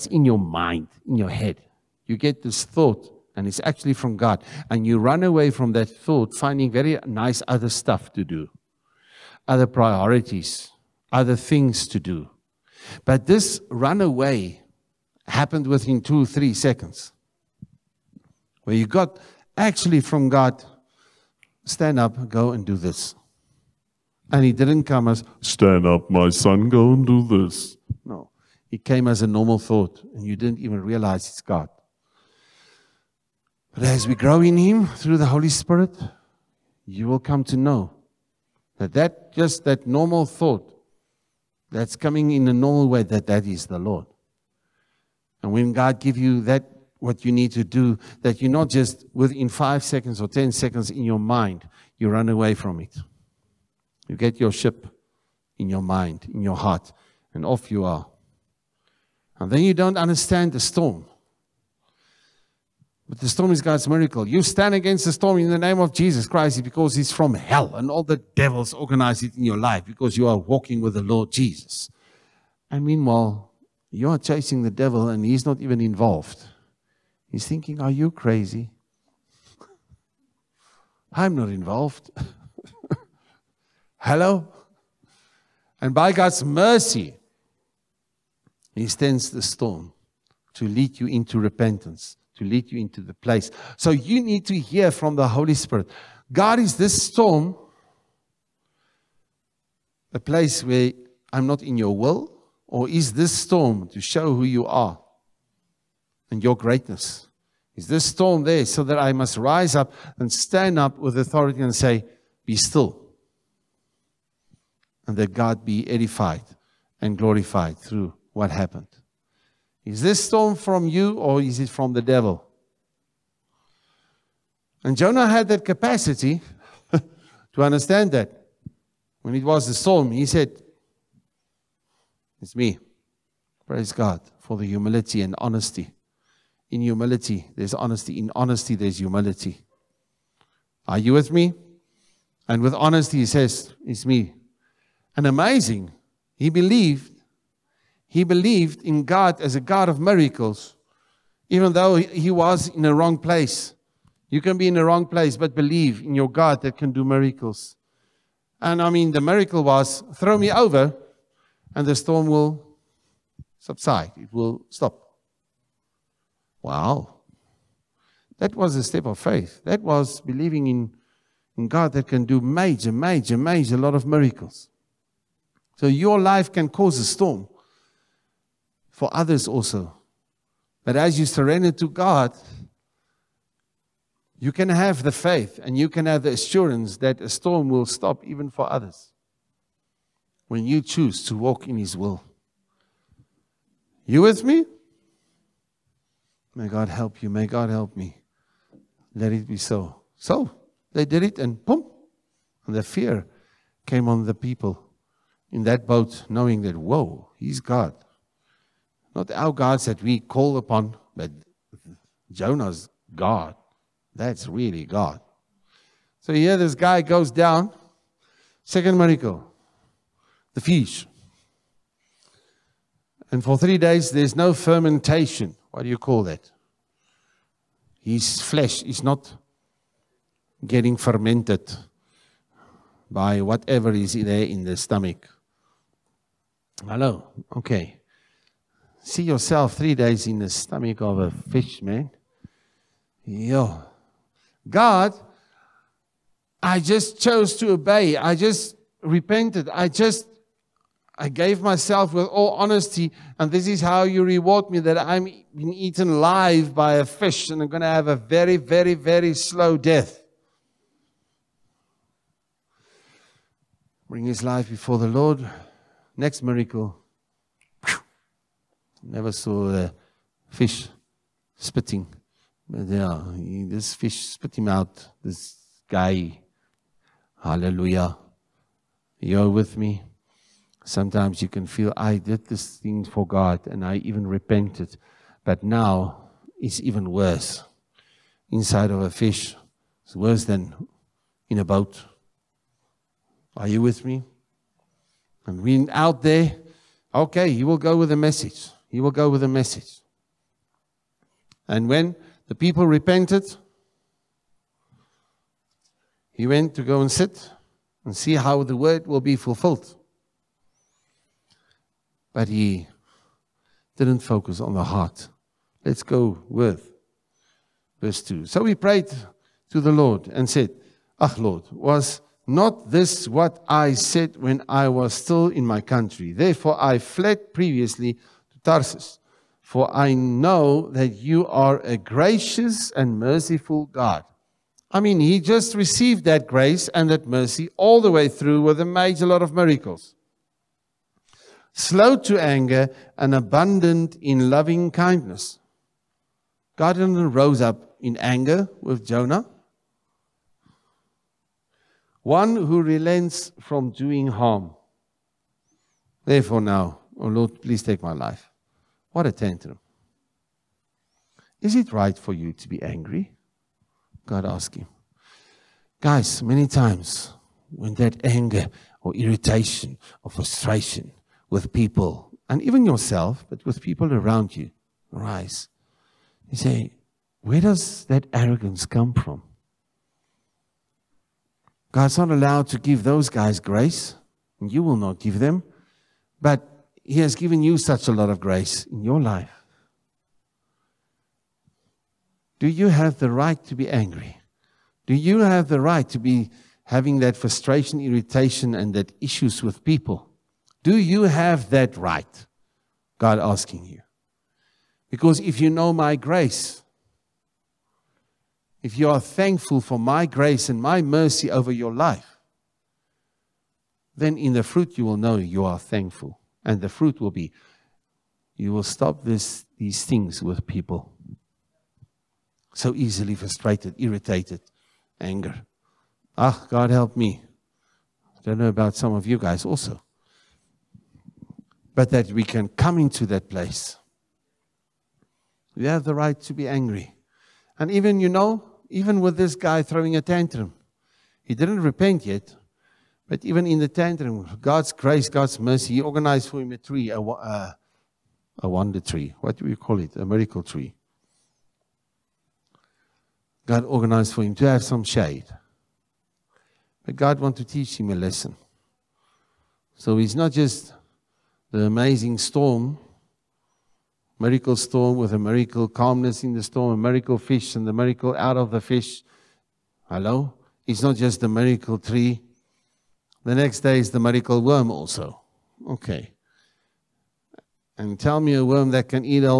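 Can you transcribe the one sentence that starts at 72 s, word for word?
And meanwhile, you are chasing the devil and he's not even involved.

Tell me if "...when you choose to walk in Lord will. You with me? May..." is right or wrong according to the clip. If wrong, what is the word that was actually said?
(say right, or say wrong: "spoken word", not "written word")
wrong: "His", not "Lord".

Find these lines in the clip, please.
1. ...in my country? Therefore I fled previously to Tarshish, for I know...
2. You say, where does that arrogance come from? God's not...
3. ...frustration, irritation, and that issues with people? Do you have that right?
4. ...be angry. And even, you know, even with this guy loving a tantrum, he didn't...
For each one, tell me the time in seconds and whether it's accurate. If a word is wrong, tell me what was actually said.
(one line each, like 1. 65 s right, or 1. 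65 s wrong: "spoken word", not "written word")
1. 325 s right
2. 376 s right
3. 397 s right
4. 436 s wrong: "throwing", not "loving".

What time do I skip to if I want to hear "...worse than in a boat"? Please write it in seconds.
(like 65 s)
290 s.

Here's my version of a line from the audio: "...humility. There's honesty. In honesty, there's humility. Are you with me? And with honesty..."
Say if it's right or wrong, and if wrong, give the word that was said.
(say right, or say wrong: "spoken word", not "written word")
right.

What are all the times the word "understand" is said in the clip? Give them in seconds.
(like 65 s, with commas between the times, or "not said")
59 s, 127 s.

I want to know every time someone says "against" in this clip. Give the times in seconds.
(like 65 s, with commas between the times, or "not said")
64 s.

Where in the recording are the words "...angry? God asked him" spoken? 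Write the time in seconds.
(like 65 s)
362 s.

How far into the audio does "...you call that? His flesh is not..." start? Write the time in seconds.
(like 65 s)
225 s.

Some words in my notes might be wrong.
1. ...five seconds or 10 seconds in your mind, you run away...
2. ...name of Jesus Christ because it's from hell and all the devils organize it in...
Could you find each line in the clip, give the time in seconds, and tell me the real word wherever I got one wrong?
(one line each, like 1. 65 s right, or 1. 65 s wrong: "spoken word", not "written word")
1. 49 s right
2. 65 s right.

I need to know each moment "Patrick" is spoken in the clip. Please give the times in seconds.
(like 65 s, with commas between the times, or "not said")
not said.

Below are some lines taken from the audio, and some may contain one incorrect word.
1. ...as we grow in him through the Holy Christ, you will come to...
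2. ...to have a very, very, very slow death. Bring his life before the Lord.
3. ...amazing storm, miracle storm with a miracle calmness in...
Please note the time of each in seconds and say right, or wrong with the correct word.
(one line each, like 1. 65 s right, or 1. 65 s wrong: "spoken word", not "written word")
1. 33 s wrong: "Spirit", not "Christ"
2. 257 s right
3. 461 s right.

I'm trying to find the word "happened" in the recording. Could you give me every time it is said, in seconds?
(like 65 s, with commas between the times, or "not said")
15 s, 118 s.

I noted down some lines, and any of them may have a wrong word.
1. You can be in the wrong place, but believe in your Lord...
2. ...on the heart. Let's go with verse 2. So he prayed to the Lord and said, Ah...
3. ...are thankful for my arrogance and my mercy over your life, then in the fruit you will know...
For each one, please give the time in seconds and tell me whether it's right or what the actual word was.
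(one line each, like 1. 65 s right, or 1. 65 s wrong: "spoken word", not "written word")
1. 154 s wrong: "God", not "Lord"
2. 314 s right
3. 409 s wrong: "grace", not "arrogance".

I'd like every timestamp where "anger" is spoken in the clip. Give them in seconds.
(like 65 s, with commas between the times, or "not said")
342 s, 348 s, 368 s, 425 s.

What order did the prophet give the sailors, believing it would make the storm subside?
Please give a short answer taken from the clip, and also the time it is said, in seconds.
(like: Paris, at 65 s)
throw me over, at 160 s.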